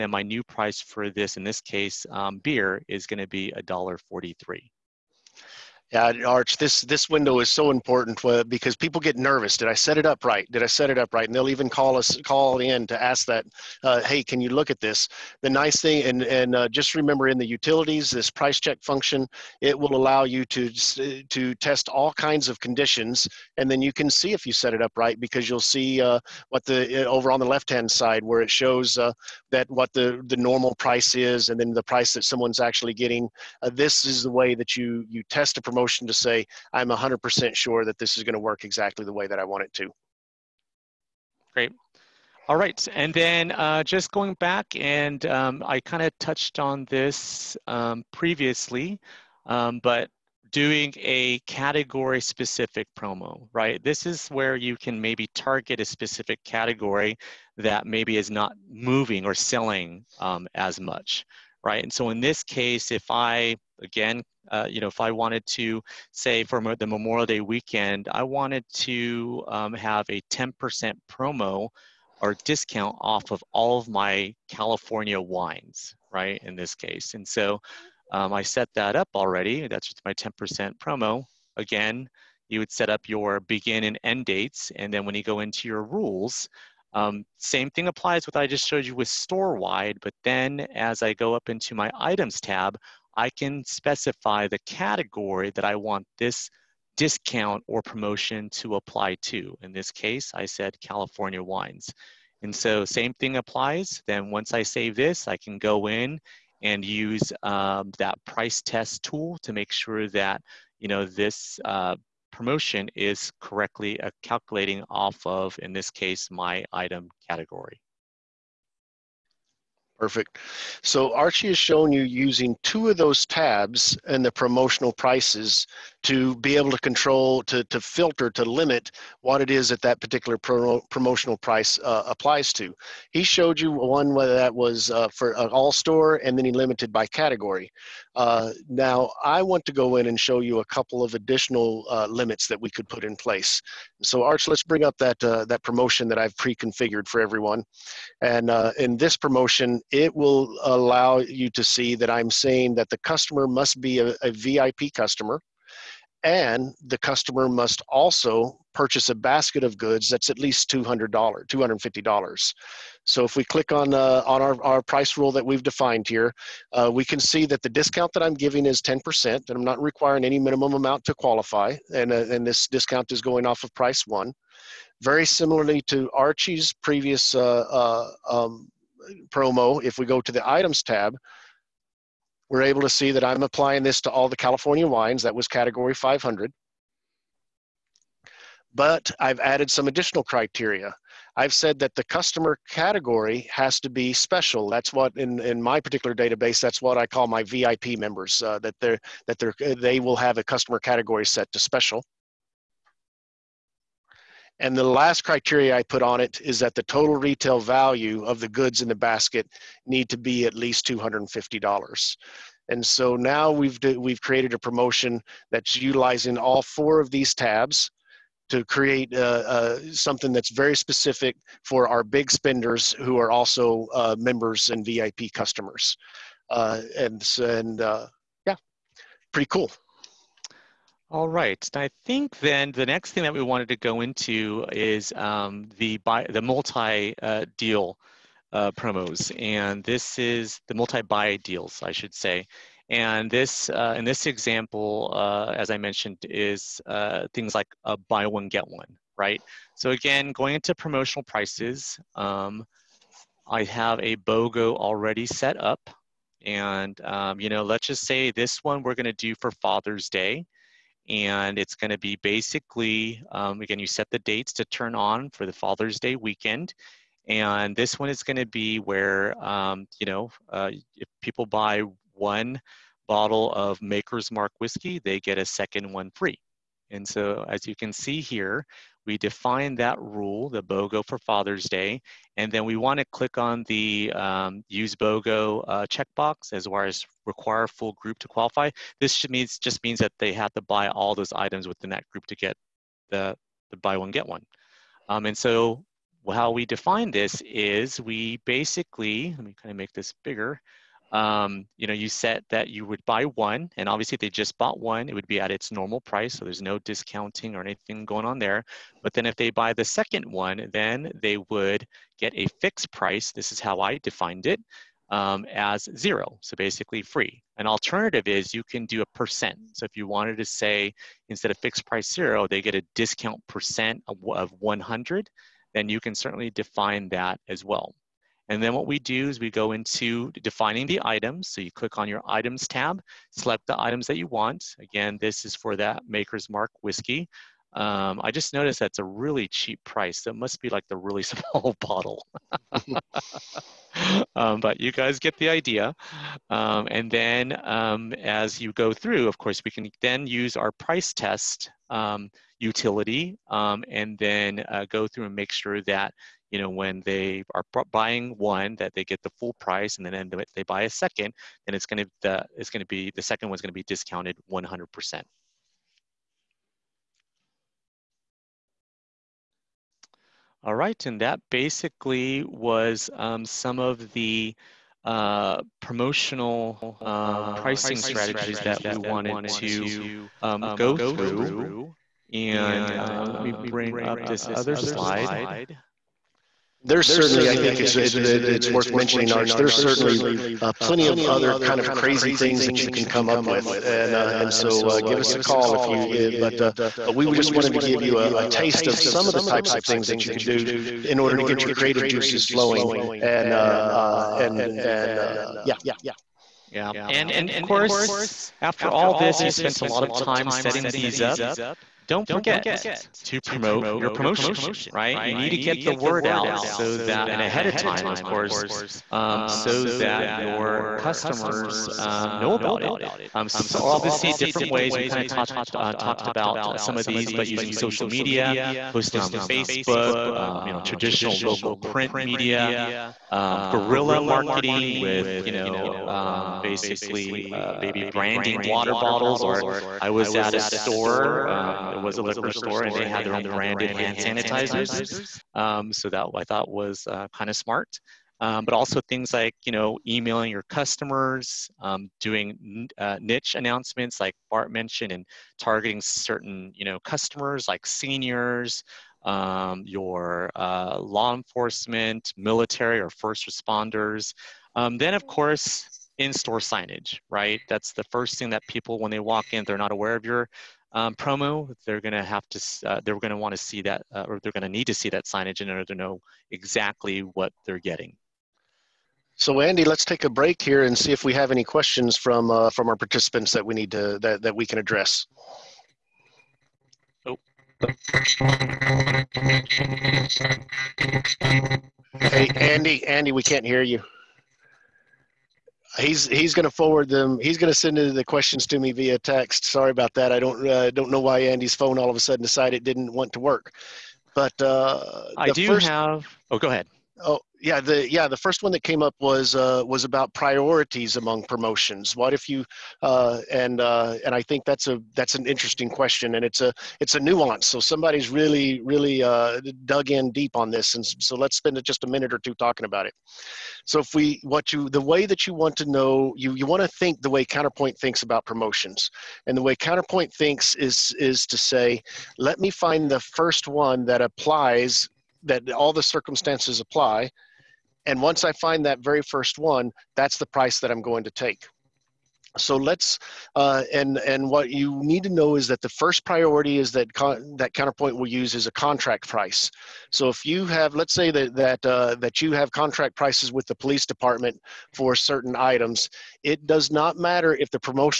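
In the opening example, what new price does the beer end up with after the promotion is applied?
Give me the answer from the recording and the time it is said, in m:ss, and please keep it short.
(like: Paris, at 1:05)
$1.43, at 0:03.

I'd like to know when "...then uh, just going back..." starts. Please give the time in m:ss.
0:43.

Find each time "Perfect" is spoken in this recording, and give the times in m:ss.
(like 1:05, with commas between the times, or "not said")
2:00.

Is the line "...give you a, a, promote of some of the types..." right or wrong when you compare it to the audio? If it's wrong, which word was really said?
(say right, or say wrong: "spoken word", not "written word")
wrong: "taste", not "promote".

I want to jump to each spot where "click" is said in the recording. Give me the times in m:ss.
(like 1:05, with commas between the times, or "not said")
2:43, 4:43, 5:31.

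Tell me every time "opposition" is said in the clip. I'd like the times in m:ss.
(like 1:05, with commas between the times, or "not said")
not said.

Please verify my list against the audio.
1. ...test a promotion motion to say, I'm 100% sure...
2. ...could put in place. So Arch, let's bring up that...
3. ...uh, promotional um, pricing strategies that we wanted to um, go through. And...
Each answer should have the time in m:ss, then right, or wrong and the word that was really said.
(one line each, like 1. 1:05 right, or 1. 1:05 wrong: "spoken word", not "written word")
1. 0:35 right
2. 2:22 right
3. 6:15 right.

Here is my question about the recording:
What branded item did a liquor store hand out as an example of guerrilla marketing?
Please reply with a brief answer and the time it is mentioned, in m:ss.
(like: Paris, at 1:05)
Hand sanitizers, at 7:23.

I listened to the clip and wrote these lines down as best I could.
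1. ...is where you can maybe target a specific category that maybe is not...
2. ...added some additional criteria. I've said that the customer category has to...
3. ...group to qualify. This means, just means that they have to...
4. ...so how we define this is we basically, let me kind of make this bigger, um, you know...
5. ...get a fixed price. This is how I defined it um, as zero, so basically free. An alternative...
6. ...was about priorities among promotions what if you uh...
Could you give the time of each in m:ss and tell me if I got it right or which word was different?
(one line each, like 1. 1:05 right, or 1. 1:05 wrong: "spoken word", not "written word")
1. 0:54 right
2. 3:09 right
3. 4:47 right
4. 4:55 right
5. 5:12 right
6. 8:29 right.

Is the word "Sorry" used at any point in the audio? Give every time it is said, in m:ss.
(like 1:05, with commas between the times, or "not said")
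8:19.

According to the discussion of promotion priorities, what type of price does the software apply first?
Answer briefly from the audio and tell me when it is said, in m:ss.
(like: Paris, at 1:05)
Contract price, at 9:08.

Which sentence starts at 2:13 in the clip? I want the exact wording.
He showed you one whether that was uh, for an all store and then he limited by category.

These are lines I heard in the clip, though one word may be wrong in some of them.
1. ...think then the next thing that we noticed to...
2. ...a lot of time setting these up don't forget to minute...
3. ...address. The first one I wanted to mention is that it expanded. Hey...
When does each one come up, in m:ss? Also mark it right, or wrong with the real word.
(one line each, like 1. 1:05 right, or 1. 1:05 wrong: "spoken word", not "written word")
1. 3:52 wrong: "wanted", not "noticed"
2. 6:49 wrong: "promote", not "minute"
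3. 8:04 right.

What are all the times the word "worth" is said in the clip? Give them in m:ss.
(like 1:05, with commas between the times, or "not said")
6:28.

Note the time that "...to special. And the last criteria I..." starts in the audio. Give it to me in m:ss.
3:21.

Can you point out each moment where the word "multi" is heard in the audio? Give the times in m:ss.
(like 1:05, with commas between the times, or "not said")
3:56, 4:00.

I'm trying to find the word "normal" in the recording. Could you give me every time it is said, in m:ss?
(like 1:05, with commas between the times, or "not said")
0:30, 5:05.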